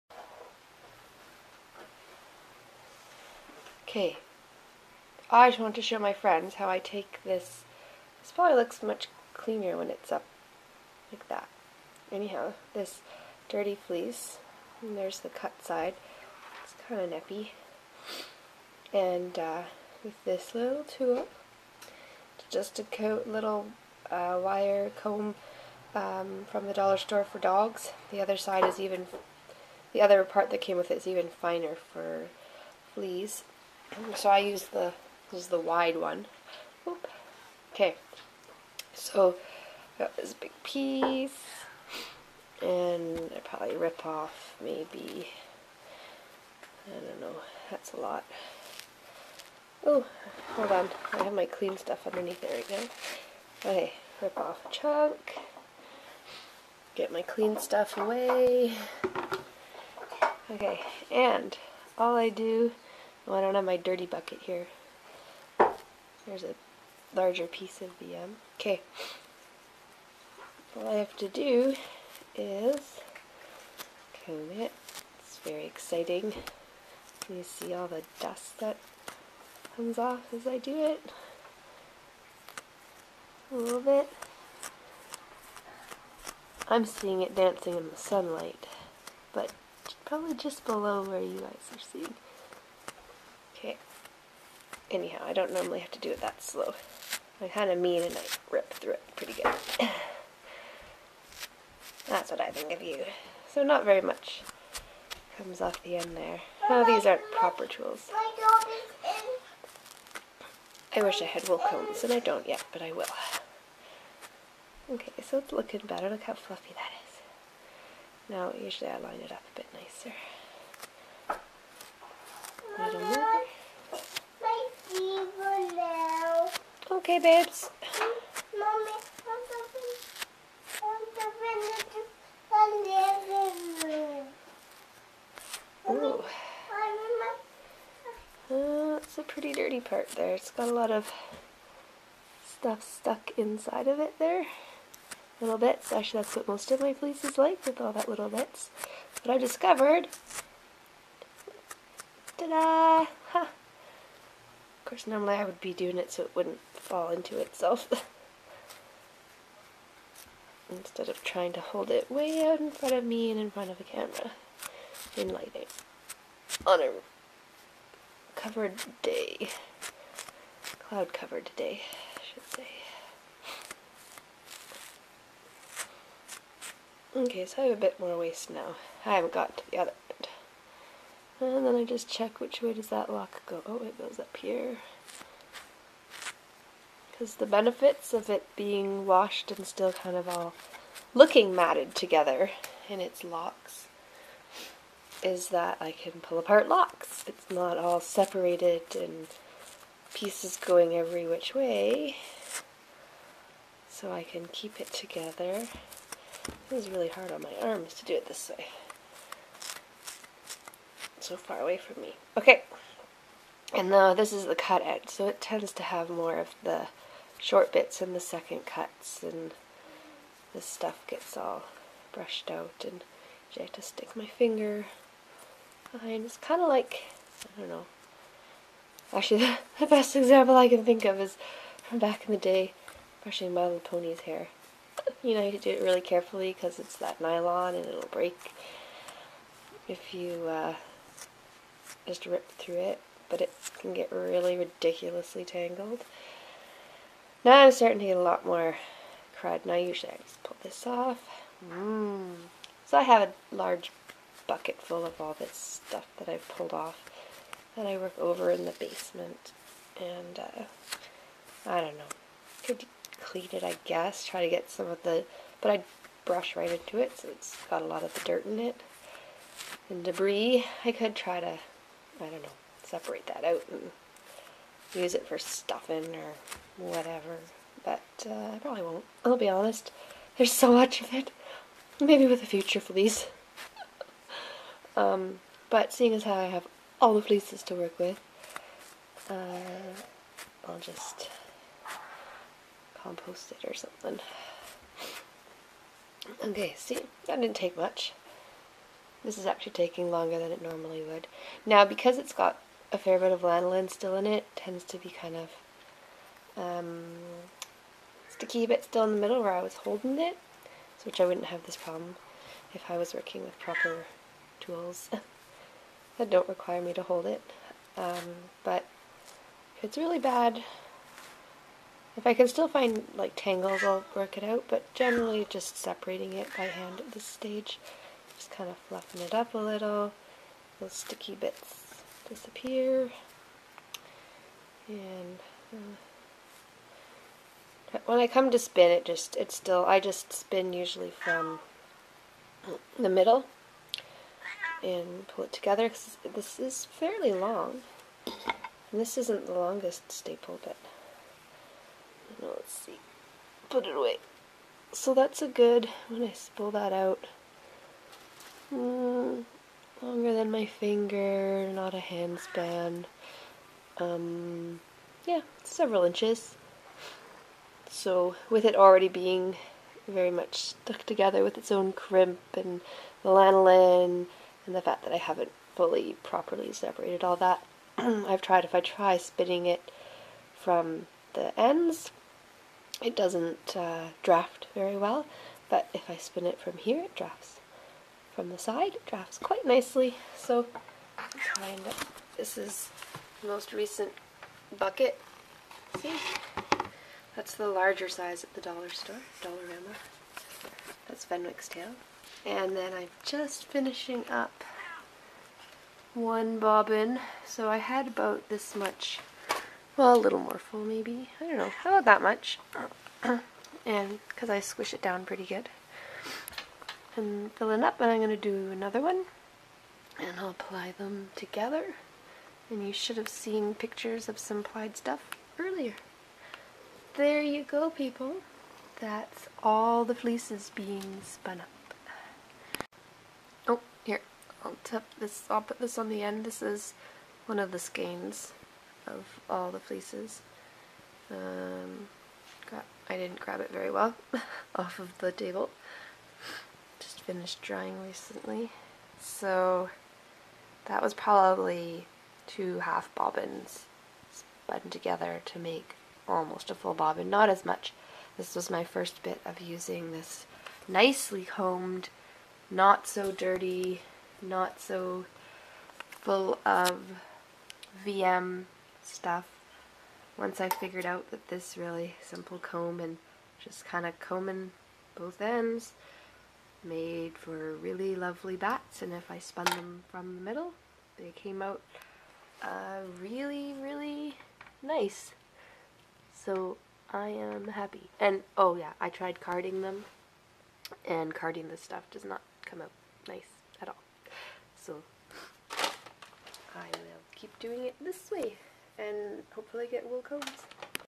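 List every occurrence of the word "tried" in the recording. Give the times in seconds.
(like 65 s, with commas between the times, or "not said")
378 s, 489 s.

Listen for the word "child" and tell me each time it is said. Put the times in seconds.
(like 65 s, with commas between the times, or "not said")
not said.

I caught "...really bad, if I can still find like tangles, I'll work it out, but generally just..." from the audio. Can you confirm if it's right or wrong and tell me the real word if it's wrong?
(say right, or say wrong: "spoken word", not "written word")
right.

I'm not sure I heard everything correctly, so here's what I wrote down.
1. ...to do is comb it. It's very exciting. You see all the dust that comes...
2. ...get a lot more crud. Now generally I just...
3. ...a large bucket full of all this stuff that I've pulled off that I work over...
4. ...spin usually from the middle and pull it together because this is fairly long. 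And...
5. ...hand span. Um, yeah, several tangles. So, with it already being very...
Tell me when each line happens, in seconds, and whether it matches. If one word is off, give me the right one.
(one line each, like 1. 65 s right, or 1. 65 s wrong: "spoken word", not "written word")
1. 71 s right
2. 248 s wrong: "usually", not "generally"
3. 253 s right
4. 340 s right
5. 361 s wrong: "inches", not "tangles".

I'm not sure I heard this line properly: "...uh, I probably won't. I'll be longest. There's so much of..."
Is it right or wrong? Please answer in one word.
wrong.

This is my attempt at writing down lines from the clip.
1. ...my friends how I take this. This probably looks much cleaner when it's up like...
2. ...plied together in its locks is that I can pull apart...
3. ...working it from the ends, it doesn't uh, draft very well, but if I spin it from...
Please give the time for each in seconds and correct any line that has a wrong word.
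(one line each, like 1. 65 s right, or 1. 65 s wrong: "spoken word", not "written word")
1. 5 s right
2. 191 s wrong: "matted", not "plied"
3. 379 s wrong: "spinning", not "working".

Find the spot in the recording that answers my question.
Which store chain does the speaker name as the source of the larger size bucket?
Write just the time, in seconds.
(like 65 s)
399 s.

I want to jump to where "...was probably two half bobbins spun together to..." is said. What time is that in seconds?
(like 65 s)
451 s.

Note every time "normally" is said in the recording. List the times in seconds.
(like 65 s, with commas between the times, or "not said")
95 s, 155 s, 300 s.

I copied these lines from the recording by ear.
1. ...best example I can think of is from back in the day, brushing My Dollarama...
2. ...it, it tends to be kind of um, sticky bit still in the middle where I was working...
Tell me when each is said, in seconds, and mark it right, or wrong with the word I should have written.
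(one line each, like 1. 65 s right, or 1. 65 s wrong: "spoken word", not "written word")
1. 229 s wrong: "Little", not "Dollarama"
2. 304 s wrong: "holding", not "working".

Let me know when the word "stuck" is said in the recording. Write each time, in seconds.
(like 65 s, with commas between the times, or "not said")
142 s, 370 s.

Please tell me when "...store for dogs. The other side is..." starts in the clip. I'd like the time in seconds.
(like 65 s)
26 s.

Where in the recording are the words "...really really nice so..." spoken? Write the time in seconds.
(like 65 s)
483 s.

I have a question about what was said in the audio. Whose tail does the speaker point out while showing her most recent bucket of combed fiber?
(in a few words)
Fenwick's.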